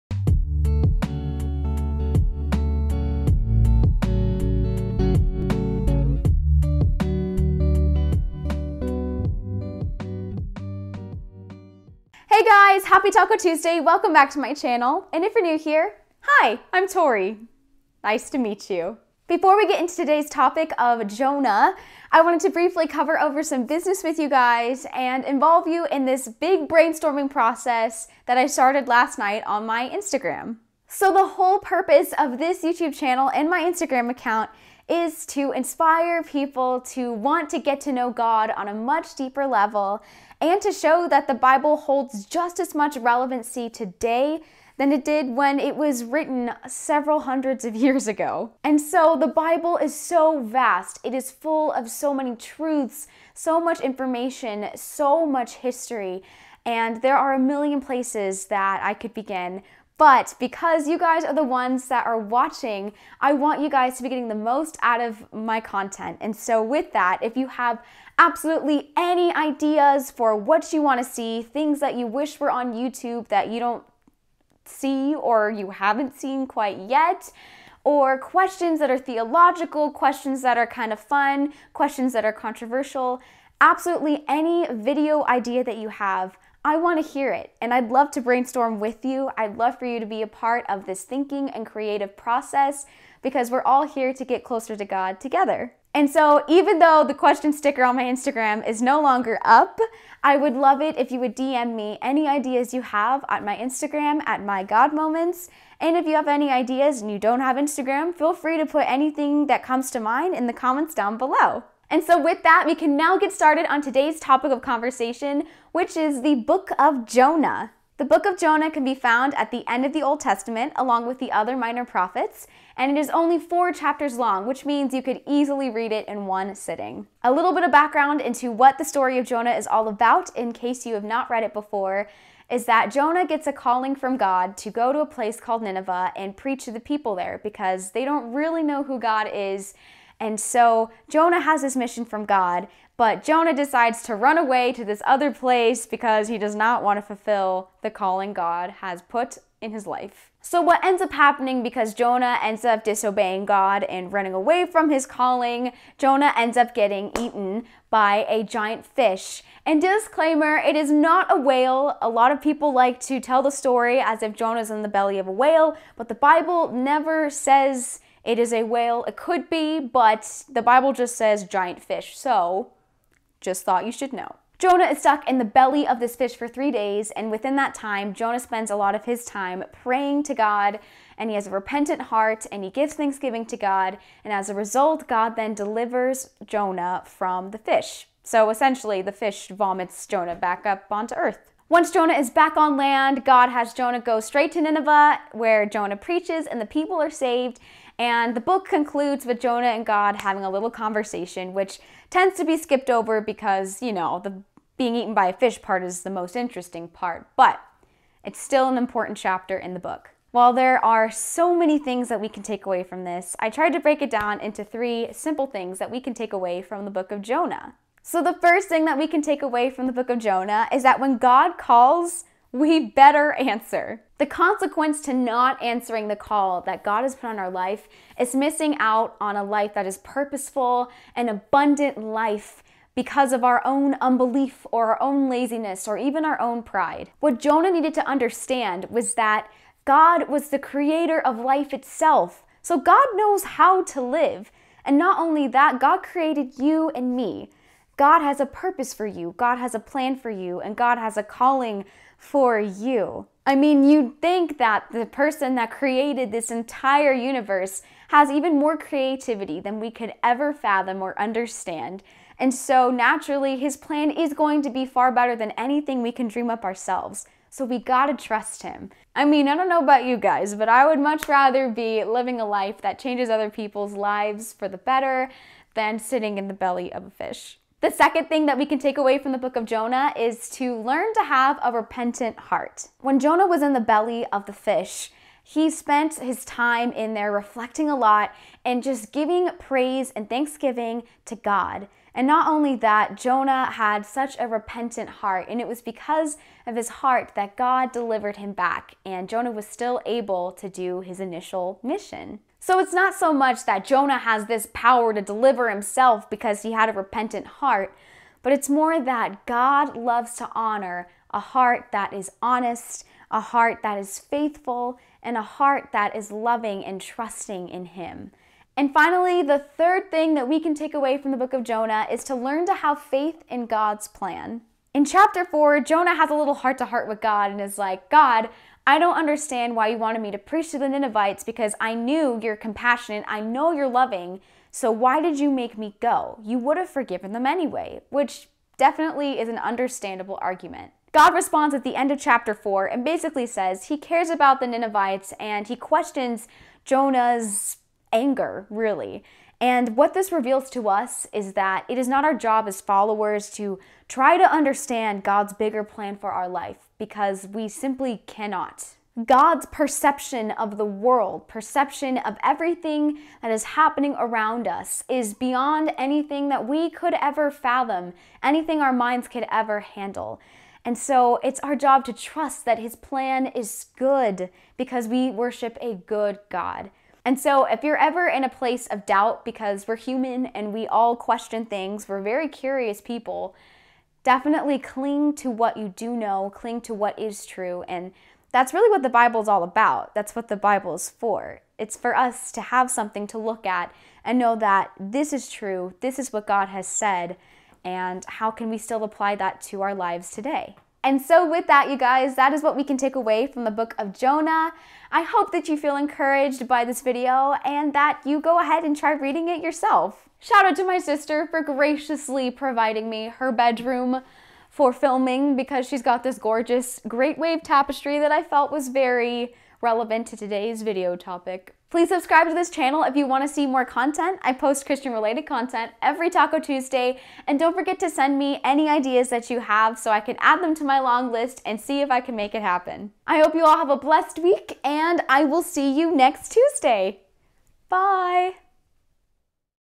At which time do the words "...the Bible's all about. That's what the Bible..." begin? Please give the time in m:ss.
6:29.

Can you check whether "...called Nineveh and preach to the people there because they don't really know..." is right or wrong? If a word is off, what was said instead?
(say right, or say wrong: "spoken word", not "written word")
right.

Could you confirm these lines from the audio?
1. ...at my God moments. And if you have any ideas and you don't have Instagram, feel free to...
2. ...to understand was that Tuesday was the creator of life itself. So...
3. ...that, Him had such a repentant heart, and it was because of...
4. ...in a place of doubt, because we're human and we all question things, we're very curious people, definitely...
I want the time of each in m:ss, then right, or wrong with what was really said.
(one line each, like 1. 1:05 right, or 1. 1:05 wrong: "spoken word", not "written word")
1. 1:44 right
2. 3:57 wrong: "God", not "Tuesday"
3. 4:52 wrong: "Jonah", not "Him"
4. 6:18 right.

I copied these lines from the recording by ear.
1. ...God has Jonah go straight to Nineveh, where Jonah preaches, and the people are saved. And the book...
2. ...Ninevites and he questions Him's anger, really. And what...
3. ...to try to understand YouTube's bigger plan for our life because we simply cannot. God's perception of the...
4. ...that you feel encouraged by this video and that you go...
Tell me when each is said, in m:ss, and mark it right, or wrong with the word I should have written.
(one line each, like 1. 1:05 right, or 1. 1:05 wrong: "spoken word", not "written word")
1. 3:13 right
2. 5:44 wrong: "Jonah", not "Him"
3. 5:53 wrong: "God", not "YouTube"
4. 6:45 right.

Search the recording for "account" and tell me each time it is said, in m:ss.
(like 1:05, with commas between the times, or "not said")
0:34.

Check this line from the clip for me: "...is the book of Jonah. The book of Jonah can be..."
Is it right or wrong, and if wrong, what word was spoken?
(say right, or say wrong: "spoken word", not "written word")
right.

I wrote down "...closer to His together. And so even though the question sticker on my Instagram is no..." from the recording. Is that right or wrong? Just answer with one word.
wrong.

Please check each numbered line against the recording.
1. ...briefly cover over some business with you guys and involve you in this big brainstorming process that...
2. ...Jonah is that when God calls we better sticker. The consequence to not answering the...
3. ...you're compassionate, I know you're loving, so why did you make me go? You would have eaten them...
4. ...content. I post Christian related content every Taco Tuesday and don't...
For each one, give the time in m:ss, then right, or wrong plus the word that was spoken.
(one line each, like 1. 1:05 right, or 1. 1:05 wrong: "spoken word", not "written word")
1. 0:22 right
2. 3:40 wrong: "answer", not "sticker"
3. 5:32 wrong: "forgiven", not "eaten"
4. 7:03 right.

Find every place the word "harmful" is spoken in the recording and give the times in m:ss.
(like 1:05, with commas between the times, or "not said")
not said.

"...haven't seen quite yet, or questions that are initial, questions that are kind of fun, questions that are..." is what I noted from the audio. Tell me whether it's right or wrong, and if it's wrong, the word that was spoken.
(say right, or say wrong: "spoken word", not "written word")
wrong: "theological", not "initial".